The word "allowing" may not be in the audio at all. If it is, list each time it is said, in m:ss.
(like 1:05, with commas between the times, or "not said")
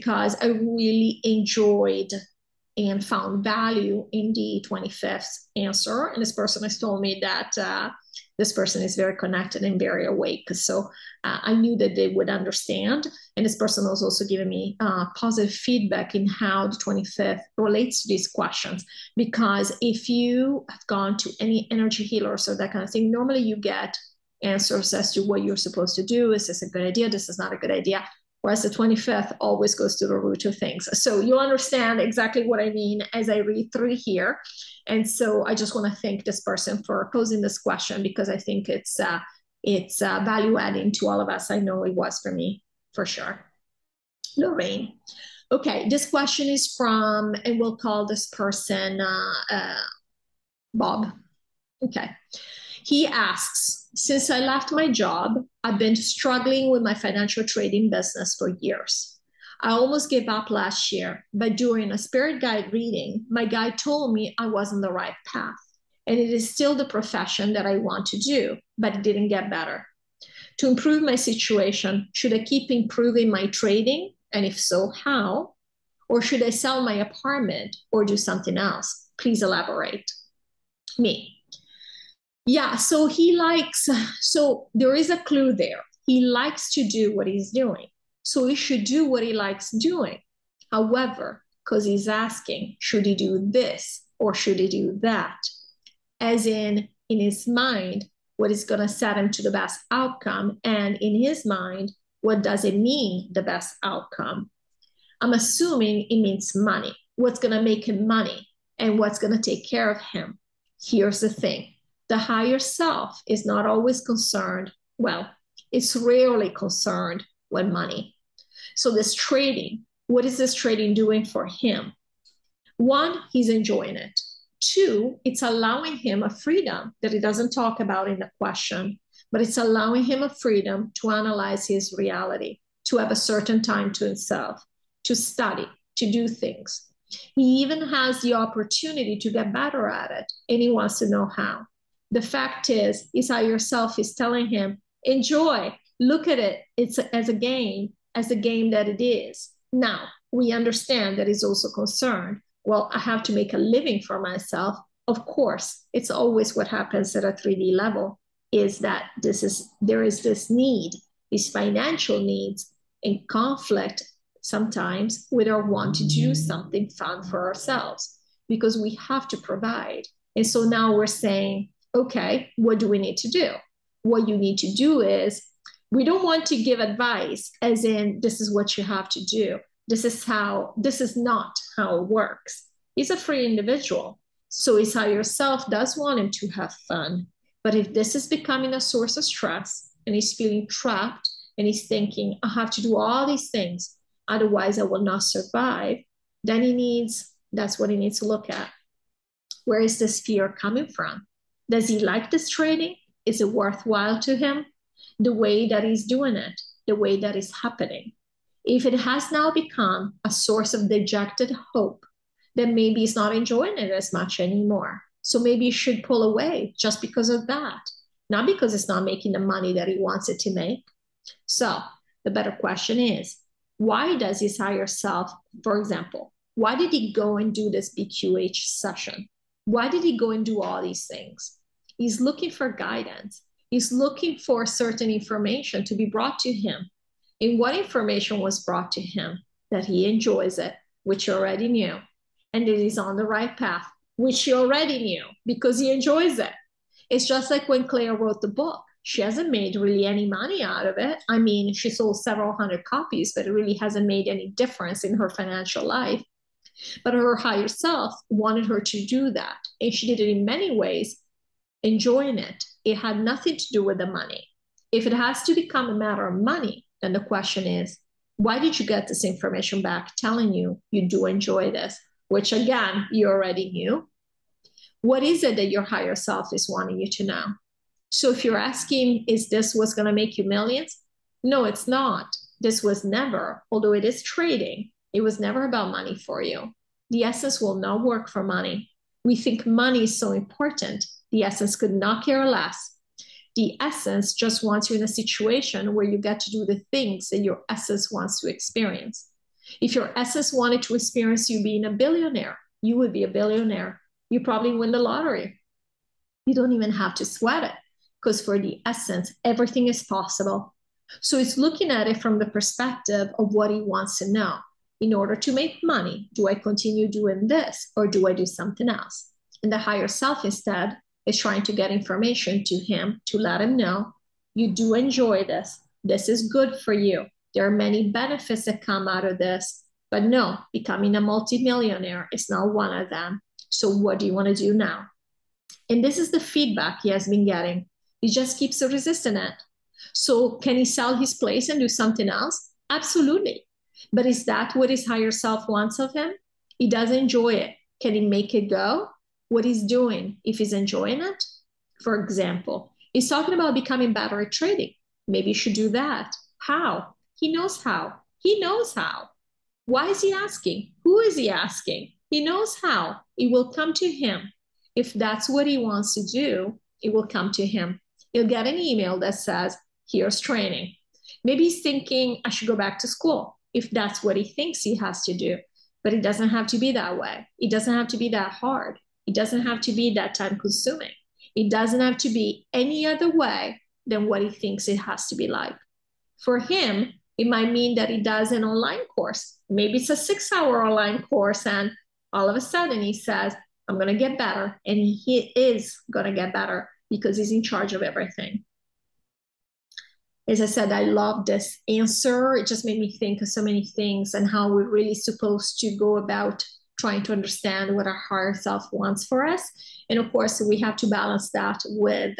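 2:05, 2:09.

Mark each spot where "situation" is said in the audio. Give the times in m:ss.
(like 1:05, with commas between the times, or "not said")
1:11, 4:55.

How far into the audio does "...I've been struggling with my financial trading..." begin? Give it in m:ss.
0:55.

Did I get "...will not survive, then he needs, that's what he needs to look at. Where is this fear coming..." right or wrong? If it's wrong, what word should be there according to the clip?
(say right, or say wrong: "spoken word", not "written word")
right.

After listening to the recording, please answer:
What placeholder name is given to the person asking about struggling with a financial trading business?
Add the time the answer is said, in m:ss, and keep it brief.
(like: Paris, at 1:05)
Bob, at 0:50.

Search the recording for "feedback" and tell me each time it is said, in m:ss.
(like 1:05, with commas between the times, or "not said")
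0:15, 5:36.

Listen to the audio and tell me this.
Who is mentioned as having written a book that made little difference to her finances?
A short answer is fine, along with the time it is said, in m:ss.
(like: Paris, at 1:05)
Clea, at 4:07.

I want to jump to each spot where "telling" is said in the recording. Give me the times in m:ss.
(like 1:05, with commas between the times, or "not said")
2:24, 4:30.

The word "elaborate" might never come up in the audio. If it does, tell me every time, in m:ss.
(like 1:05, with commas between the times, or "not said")
1:19.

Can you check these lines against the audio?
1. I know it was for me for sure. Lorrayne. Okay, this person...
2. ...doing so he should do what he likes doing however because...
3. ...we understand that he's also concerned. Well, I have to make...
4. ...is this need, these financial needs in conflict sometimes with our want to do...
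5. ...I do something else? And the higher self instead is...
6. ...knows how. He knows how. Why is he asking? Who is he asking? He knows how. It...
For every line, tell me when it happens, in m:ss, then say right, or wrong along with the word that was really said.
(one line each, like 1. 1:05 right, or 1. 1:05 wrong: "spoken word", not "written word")
1. 0:41 wrong: "question", not "person"
2. 1:27 right
3. 2:30 right
4. 2:40 right
5. 5:18 right
6. 5:57 right.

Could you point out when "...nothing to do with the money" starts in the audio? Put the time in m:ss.
4:23.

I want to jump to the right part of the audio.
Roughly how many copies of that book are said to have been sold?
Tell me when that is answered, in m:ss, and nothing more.
4:12.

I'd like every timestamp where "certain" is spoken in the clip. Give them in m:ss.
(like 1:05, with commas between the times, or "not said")
2:13, 3:54.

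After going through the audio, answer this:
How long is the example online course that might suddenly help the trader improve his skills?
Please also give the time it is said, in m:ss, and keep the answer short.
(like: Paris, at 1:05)
6 hours, at 6:30.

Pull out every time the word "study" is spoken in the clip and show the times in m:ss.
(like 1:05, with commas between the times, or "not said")
2:15.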